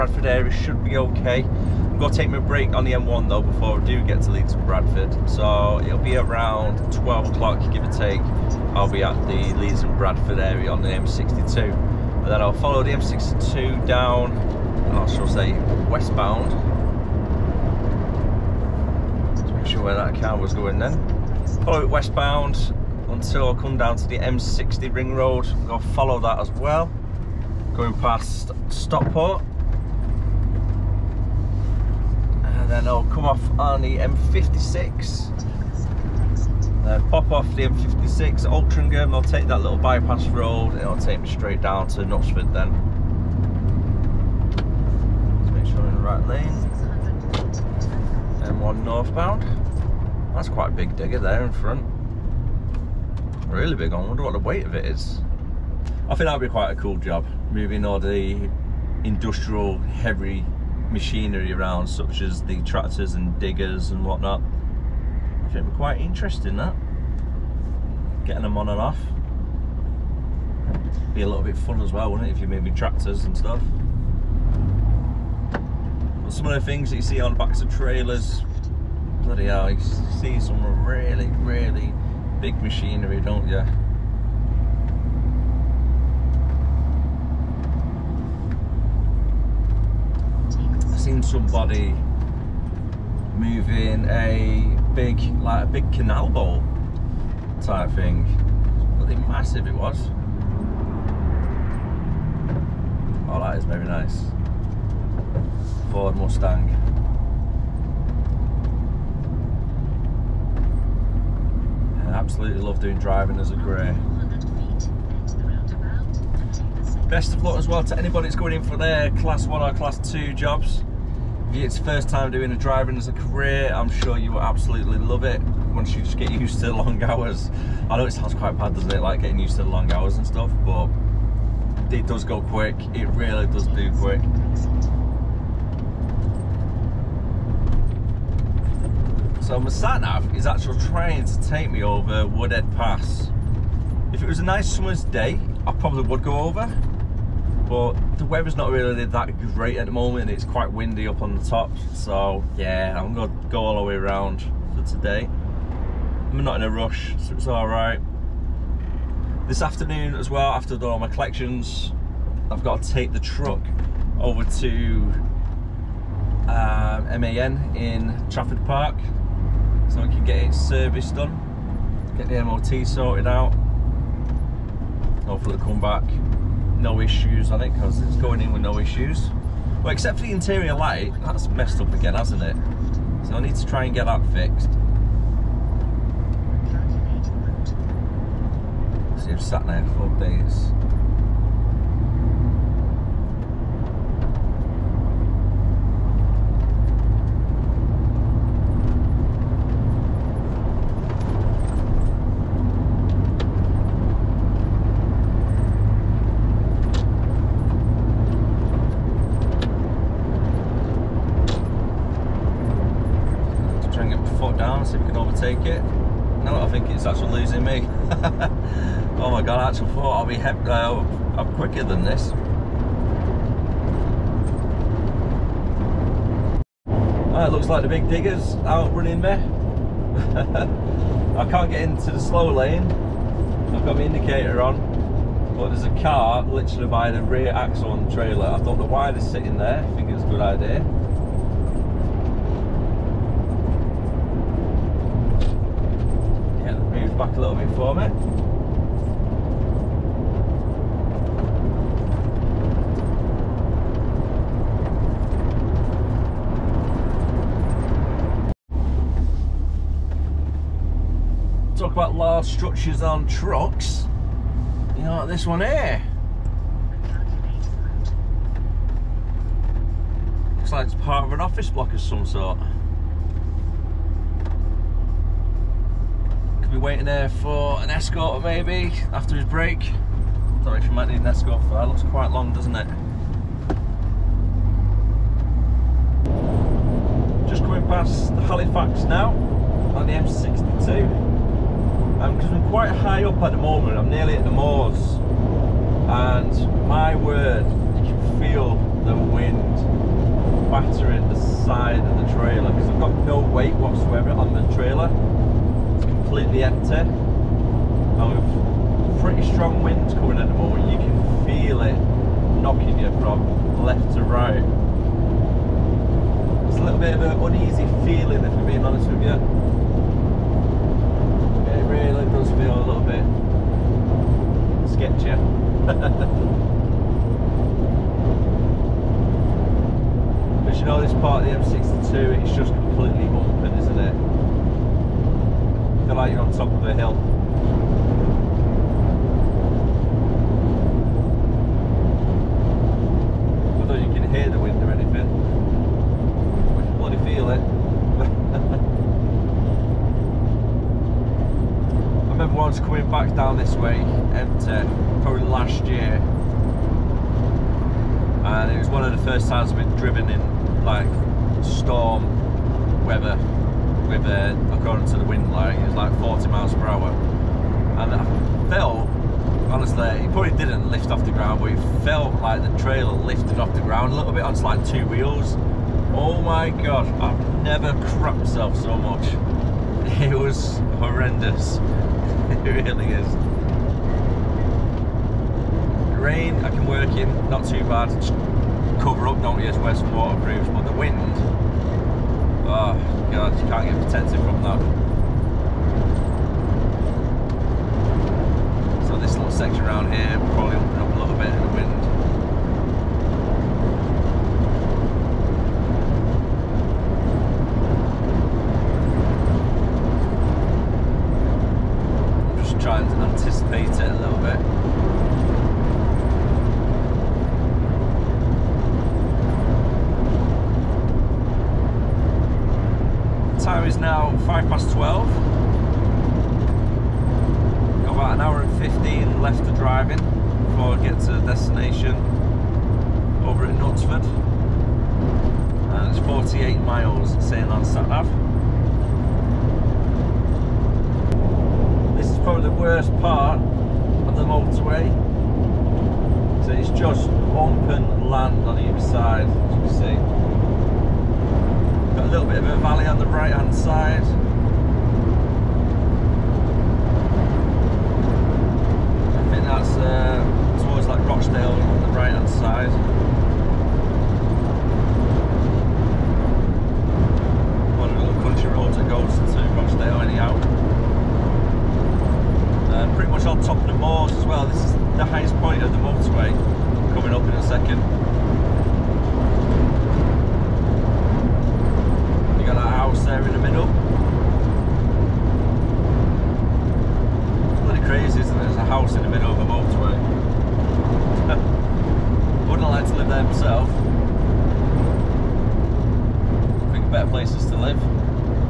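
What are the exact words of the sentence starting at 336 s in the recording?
I feel like you're on top of a hill.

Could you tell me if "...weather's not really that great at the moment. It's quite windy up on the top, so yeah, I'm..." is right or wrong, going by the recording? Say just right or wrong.
right.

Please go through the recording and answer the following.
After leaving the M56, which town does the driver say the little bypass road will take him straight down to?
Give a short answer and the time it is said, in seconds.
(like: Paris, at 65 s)
Knutsford, at 42 s.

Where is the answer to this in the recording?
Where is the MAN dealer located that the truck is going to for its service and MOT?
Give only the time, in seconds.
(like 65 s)
168 s.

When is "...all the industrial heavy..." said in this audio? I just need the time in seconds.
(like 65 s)
57 s.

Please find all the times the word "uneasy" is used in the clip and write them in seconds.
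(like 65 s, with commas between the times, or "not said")
317 s.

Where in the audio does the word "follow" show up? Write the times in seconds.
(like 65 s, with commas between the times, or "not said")
12 s, 21 s, 25 s.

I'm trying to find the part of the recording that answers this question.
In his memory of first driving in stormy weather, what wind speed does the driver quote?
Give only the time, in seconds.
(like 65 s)
366 s.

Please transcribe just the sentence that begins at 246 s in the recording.
Yeah, move back a little bit for me.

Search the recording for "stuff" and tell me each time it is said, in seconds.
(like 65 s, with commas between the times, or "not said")
73 s, 130 s.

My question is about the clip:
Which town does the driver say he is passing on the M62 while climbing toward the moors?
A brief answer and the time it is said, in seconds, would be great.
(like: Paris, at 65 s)
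Halifax, at 288 s.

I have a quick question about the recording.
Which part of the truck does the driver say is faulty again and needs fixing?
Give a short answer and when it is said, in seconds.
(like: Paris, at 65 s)
interior light, at 180 s.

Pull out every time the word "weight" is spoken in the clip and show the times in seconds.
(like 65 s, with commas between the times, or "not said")
54 s, 303 s.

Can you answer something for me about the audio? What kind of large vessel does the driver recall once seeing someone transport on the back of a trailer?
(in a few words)
canal boat.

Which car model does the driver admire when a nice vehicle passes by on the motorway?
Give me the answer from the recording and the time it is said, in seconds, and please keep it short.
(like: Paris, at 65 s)
Ford Mustang, at 105 s.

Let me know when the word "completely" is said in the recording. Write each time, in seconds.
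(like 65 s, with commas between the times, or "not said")
306 s, 332 s.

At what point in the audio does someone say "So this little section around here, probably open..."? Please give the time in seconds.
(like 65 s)
399 s.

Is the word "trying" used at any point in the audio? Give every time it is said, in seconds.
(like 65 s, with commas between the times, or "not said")
140 s.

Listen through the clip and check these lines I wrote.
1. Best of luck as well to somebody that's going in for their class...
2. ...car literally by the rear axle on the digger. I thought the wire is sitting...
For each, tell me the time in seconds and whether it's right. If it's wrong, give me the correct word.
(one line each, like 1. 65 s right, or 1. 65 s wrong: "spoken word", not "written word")
1. 117 s wrong: "anybody", not "somebody"
2. 236 s wrong: "trailer", not "digger".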